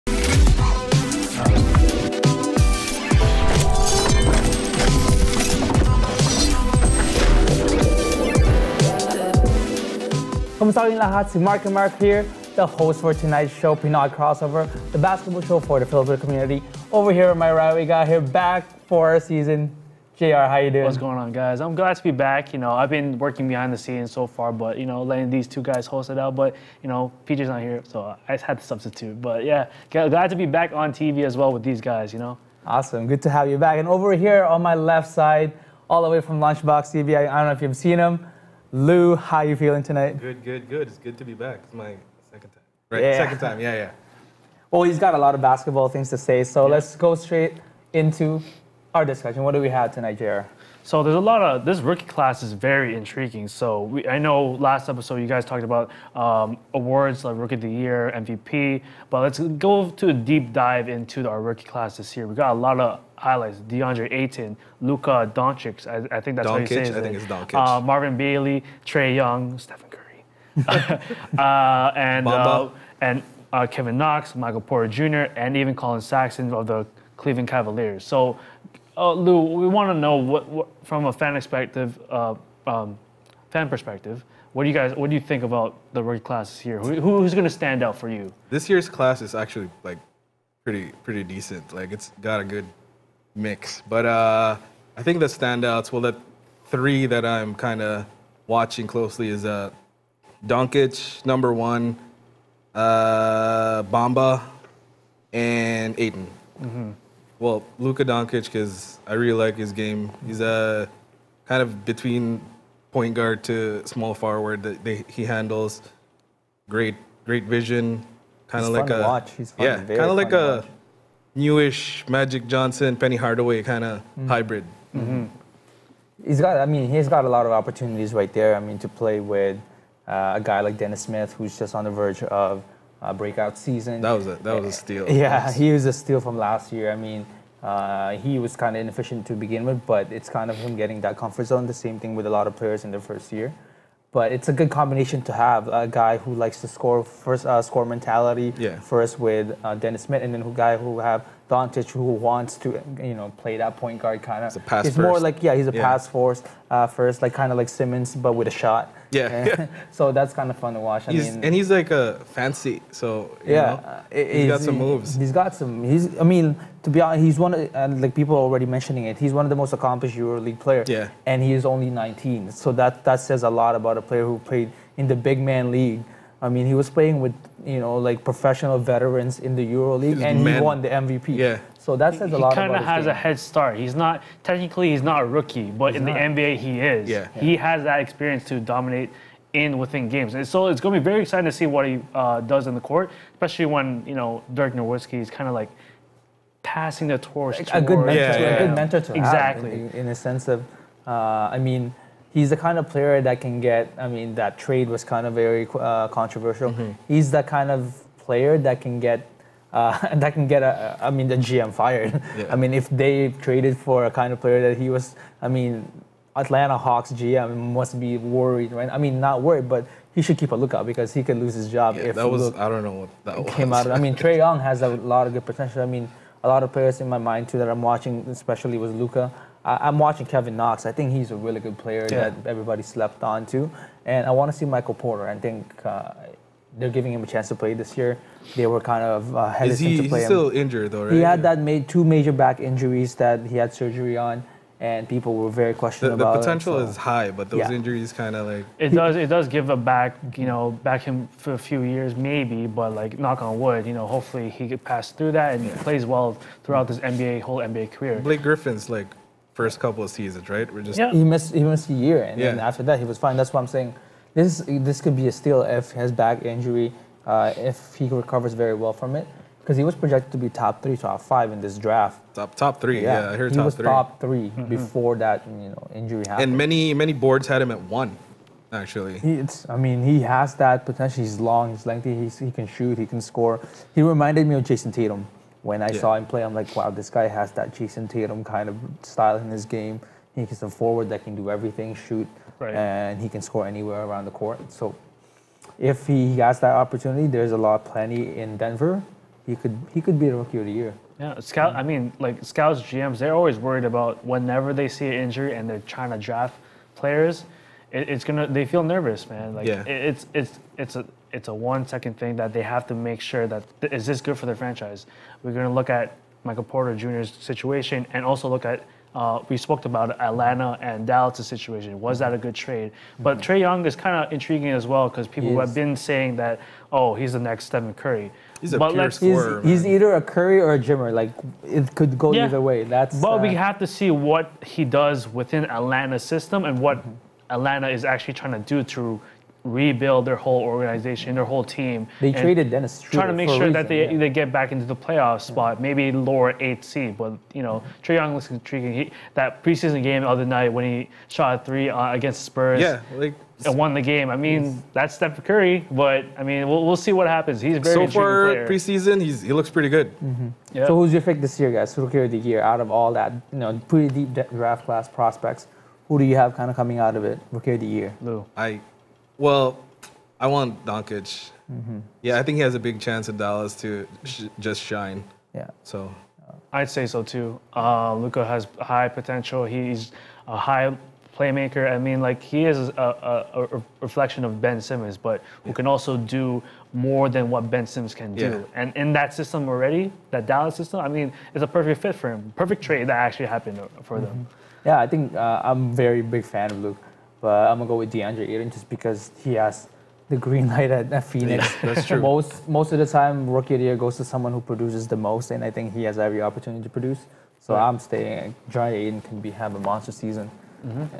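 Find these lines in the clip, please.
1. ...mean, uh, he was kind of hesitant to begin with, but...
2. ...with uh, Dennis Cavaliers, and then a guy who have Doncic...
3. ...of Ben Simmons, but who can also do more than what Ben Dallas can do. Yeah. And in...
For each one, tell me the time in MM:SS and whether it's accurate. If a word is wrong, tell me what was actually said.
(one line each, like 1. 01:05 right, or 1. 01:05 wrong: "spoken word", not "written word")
1. 02:16 wrong: "inefficient", not "hesitant"
2. 02:29 wrong: "Smith", not "Cavaliers"
3. 06:24 wrong: "Simmons", not "Dallas".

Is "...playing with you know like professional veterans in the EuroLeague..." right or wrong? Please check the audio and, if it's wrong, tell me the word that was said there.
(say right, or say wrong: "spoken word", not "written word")
right.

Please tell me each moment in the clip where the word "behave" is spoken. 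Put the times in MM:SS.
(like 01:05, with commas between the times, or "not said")
not said.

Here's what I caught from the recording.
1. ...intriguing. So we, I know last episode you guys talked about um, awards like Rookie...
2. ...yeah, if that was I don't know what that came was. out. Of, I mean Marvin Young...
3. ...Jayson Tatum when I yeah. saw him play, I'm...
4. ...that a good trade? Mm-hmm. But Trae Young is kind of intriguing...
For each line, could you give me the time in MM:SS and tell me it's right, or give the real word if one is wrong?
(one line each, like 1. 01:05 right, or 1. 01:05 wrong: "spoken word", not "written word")
1. 00:52 right
2. 03:41 wrong: "Trae", not "Marvin"
3. 04:44 right
4. 05:22 right.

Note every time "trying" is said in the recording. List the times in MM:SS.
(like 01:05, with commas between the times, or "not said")
05:05, 05:38, 05:43.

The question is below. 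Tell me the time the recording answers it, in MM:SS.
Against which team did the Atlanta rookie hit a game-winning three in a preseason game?
05:52.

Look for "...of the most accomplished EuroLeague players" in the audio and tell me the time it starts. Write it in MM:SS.
02:49.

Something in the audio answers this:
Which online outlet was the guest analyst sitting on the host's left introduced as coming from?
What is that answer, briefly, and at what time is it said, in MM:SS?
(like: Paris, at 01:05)
Lunchbox TV, at 00:36.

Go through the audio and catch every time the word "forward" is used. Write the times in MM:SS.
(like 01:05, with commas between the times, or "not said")
01:54, 04:50.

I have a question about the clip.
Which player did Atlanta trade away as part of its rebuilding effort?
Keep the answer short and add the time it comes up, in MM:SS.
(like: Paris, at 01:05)
Dennis Schroeder, at 05:42.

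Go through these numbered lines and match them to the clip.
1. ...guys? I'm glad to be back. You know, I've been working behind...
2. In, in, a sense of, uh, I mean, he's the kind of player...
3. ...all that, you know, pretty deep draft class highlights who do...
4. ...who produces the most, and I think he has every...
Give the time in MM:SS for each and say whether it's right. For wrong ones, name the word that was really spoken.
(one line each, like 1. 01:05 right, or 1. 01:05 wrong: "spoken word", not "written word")
1. 00:21 right
2. 03:19 right
3. 06:02 wrong: "prospects", not "highlights"
4. 06:44 right.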